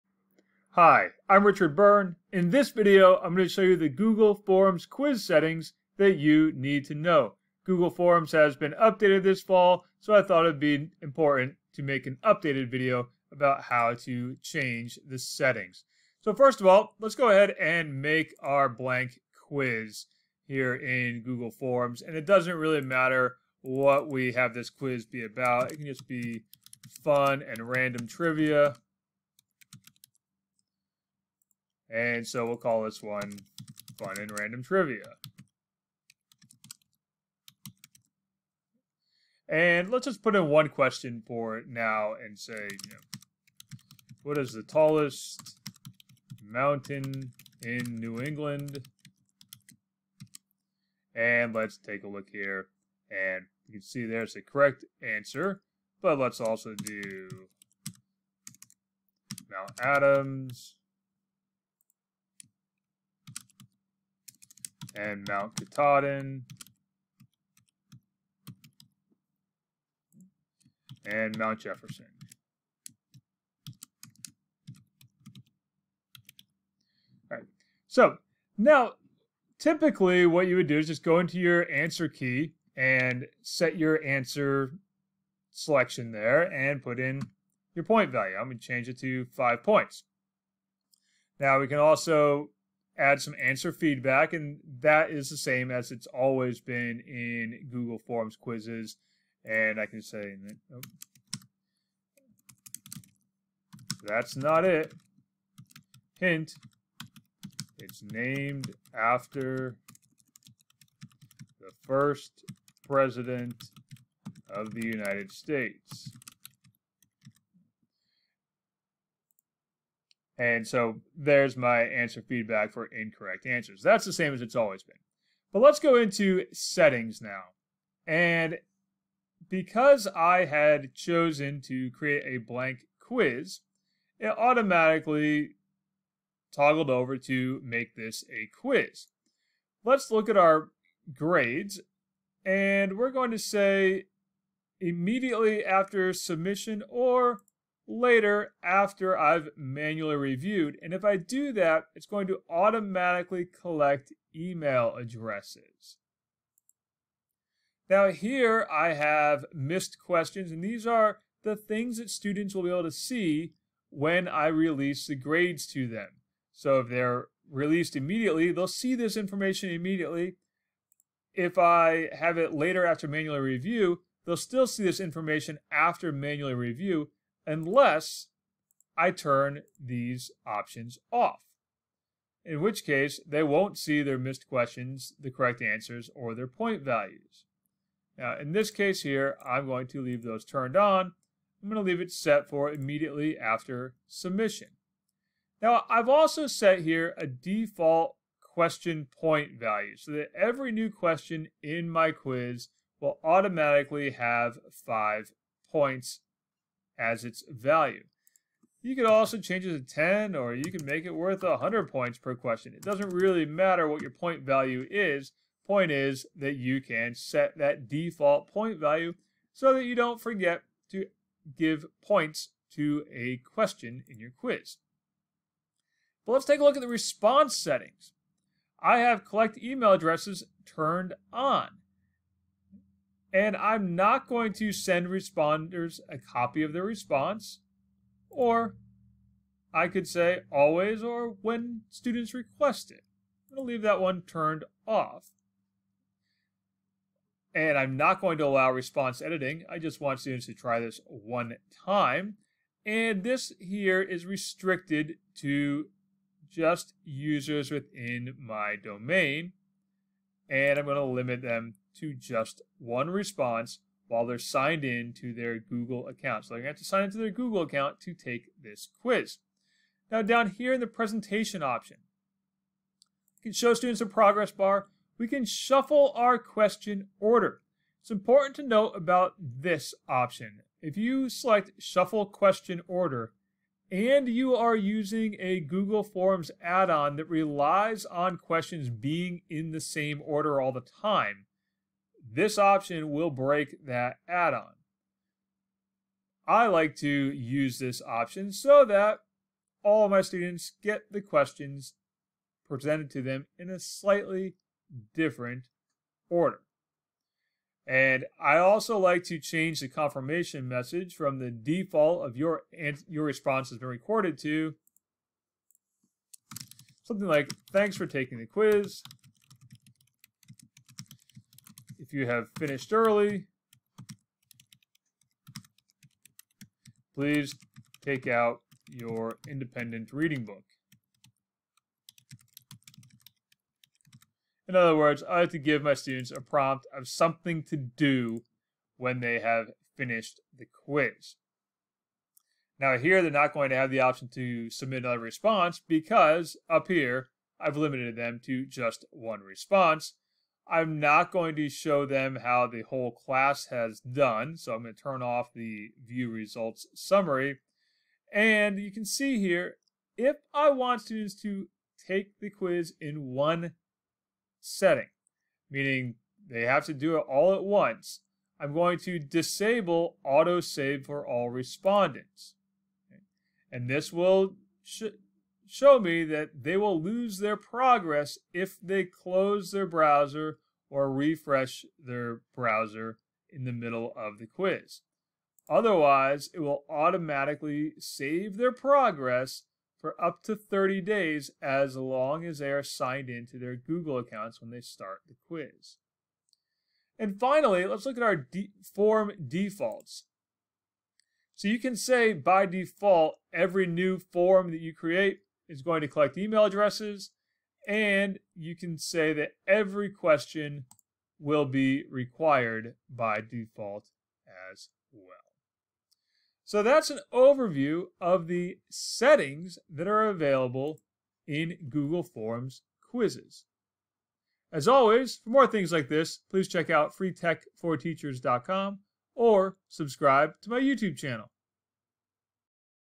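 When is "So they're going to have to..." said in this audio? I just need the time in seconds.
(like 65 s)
266 s.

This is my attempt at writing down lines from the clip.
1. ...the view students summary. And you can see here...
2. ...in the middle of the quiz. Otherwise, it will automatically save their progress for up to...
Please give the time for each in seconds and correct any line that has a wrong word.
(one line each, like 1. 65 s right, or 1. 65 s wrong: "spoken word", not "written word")
1. 355 s wrong: "results", not "students"
2. 383 s right.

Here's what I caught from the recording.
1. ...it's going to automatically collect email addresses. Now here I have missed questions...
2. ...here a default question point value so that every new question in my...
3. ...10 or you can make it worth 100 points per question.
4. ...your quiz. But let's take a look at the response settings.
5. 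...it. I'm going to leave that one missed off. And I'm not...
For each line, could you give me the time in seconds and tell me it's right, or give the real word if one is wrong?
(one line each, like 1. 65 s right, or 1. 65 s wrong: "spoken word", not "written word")
1. 151 s right
2. 196 s right
3. 209 s right
4. 224 s right
5. 242 s wrong: "turned", not "missed".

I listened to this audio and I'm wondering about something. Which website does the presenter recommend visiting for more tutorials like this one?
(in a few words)
freetechforteachers.com.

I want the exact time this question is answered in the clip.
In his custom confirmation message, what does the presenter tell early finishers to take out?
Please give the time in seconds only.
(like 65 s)
329 s.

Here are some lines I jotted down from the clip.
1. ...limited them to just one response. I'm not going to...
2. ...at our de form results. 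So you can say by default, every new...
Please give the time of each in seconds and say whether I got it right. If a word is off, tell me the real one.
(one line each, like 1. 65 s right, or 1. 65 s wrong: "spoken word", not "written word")
1. 347 s right
2. 398 s wrong: "defaults", not "results".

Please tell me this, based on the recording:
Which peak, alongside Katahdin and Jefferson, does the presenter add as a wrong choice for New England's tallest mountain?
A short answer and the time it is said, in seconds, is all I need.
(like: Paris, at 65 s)
Mount Adams, at 59 s.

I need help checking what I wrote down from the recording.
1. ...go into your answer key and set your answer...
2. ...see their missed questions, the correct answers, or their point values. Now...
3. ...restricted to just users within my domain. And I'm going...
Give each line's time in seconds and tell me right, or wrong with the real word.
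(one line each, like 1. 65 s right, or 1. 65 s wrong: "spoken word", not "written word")
1. 81 s right
2. 183 s right
3. 254 s right.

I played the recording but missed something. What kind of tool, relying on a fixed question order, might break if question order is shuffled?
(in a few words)
Google Forms add-on.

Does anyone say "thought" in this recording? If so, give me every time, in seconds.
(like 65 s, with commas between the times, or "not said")
10 s.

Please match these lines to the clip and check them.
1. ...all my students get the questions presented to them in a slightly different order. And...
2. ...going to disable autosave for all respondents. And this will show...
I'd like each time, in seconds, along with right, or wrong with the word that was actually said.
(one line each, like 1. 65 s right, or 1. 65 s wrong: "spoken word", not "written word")
1. 299 s right
2. 368 s right.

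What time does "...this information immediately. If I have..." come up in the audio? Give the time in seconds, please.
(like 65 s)
168 s.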